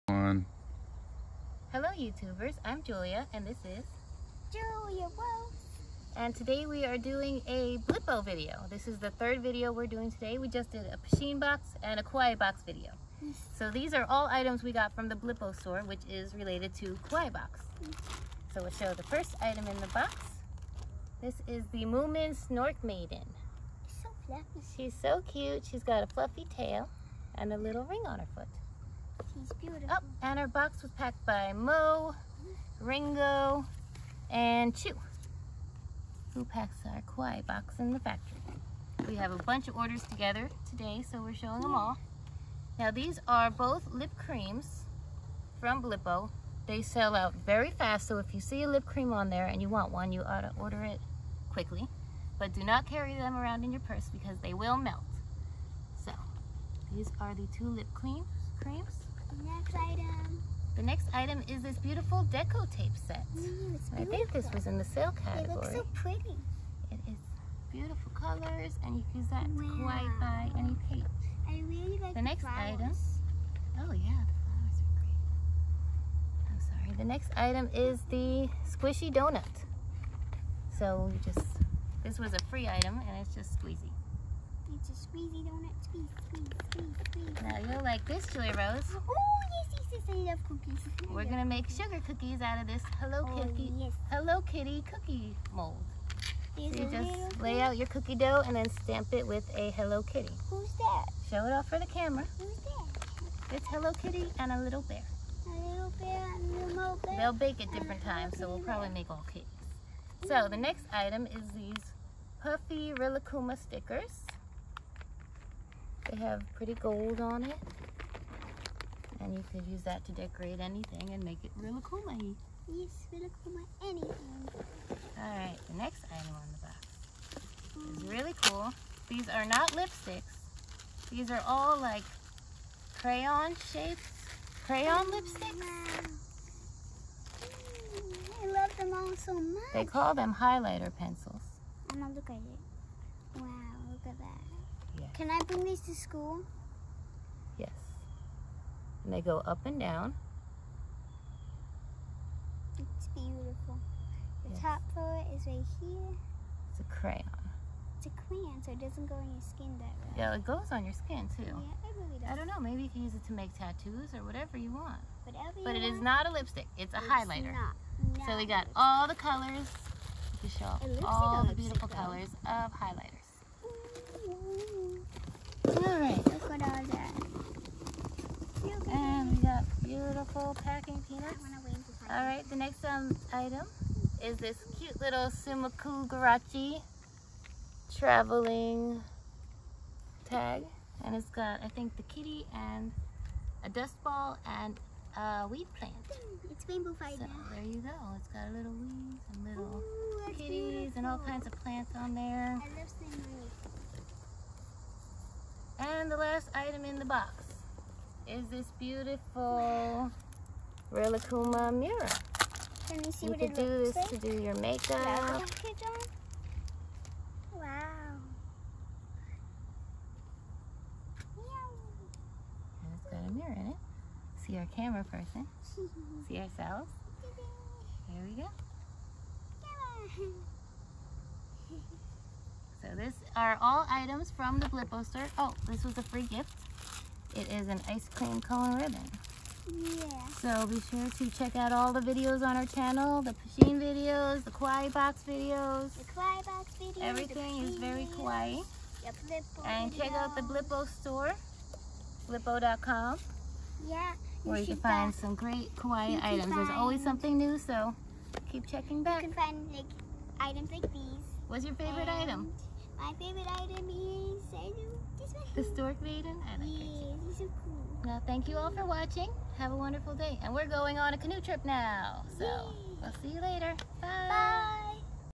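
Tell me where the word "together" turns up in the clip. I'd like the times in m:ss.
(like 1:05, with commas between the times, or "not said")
0:40.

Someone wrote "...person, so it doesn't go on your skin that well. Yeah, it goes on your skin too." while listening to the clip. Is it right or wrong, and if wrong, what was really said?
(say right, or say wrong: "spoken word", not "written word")
wrong: "crayon", not "person".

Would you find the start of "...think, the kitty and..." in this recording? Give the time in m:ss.
3:11.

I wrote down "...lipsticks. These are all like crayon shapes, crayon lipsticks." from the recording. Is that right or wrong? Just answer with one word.
right.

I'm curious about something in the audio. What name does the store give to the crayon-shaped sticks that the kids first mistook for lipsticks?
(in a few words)
Highlighter pencils.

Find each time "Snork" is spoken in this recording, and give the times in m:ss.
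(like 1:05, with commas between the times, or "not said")
0:22, 4:25.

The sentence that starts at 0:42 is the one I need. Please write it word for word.
Now these are both lip creams from Blippo.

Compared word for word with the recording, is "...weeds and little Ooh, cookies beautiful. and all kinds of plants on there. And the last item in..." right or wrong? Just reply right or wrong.
wrong.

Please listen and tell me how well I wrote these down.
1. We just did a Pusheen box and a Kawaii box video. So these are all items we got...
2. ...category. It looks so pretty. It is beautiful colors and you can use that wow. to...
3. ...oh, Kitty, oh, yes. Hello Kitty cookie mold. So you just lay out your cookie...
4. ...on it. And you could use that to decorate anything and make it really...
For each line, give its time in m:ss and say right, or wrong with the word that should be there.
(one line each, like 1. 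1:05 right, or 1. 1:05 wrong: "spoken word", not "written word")
1. 0:10 right
2. 1:05 right
3. 1:33 right
4. 1:57 right.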